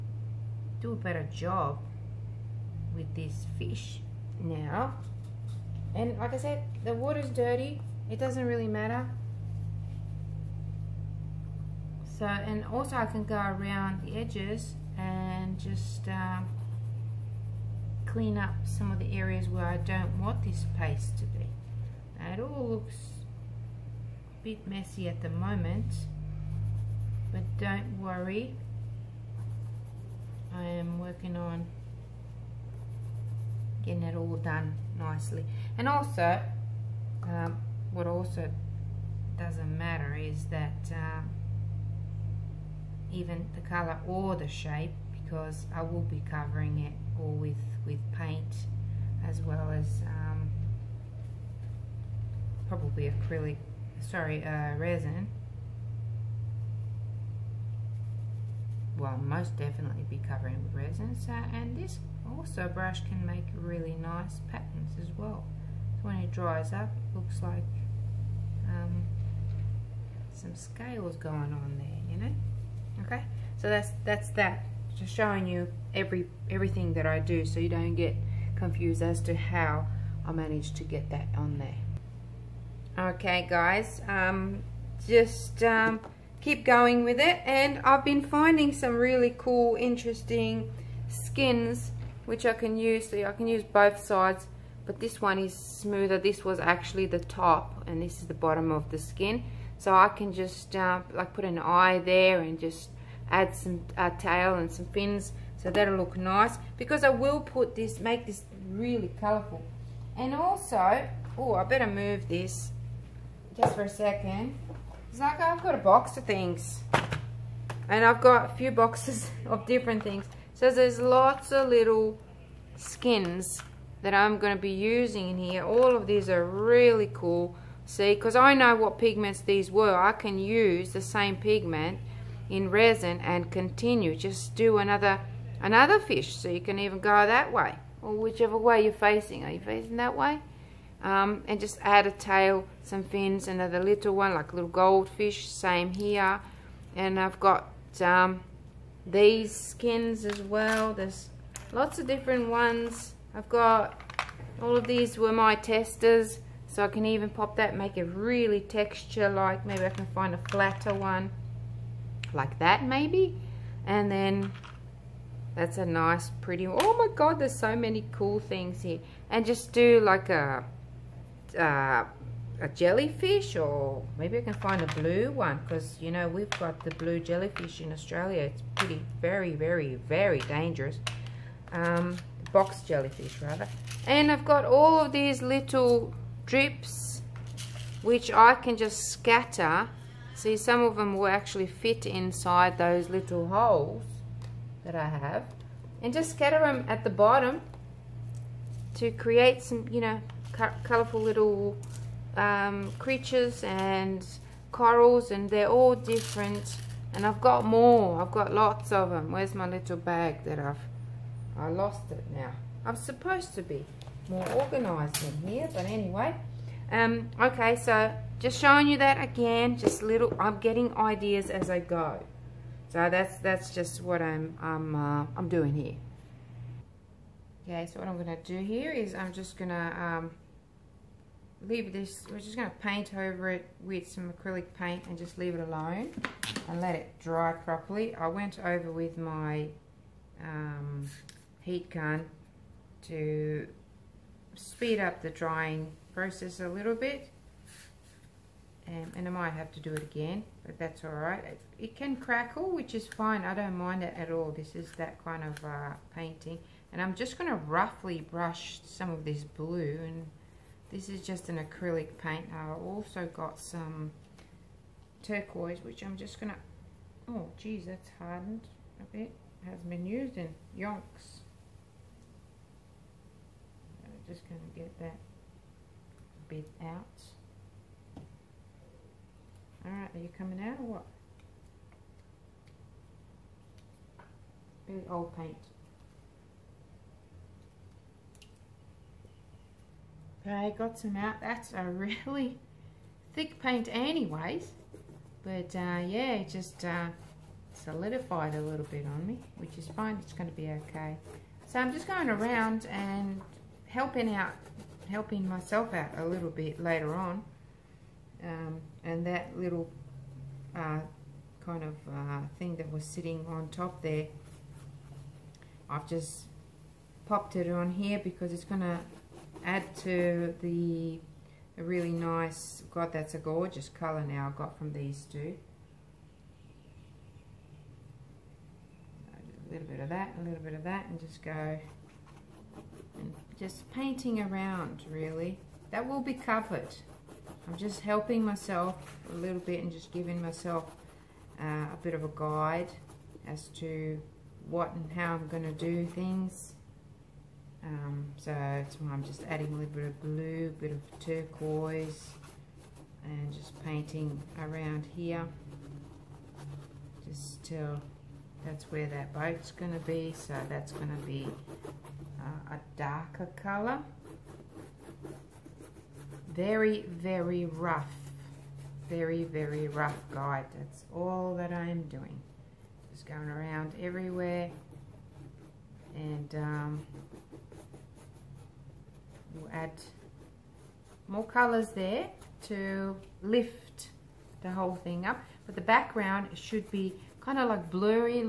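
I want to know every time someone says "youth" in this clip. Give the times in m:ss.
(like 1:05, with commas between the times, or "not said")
not said.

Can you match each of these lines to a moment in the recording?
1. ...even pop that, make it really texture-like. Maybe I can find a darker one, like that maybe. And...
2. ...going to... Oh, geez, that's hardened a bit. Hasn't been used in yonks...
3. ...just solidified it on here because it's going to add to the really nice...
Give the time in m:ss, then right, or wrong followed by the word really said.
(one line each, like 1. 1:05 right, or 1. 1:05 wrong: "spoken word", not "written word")
1. 2:37 wrong: "flatter", not "darker"
2. 4:26 right
3. 5:16 wrong: "popped", not "solidified".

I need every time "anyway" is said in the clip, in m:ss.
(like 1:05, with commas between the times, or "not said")
3:35, 4:53.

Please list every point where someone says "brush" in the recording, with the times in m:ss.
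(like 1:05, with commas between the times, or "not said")
1:02, 4:18.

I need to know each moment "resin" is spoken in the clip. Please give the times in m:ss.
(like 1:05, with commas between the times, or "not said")
0:54, 1:00, 2:12.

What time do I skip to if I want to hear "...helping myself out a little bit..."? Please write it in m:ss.
5:05.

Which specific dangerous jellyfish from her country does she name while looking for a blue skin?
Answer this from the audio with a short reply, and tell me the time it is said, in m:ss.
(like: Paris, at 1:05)
Box jellyfish, at 3:02.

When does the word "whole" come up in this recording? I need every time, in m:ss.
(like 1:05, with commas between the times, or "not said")
6:24.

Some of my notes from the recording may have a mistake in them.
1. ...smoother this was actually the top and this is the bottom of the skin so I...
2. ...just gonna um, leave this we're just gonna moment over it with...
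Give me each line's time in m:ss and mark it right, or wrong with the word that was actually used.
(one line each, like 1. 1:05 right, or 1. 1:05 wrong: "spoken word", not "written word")
1. 1:35 right
2. 3:49 wrong: "paint", not "moment".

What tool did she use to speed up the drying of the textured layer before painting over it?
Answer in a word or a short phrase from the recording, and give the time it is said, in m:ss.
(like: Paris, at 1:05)
Heat gun, at 4:01.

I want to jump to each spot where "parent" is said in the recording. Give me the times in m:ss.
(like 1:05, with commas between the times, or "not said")
not said.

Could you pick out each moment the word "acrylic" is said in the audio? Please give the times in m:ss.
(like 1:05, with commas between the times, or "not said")
0:53, 3:54, 4:21.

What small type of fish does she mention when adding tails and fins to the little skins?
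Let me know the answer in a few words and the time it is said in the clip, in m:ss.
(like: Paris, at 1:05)
Goldfish, at 2:24.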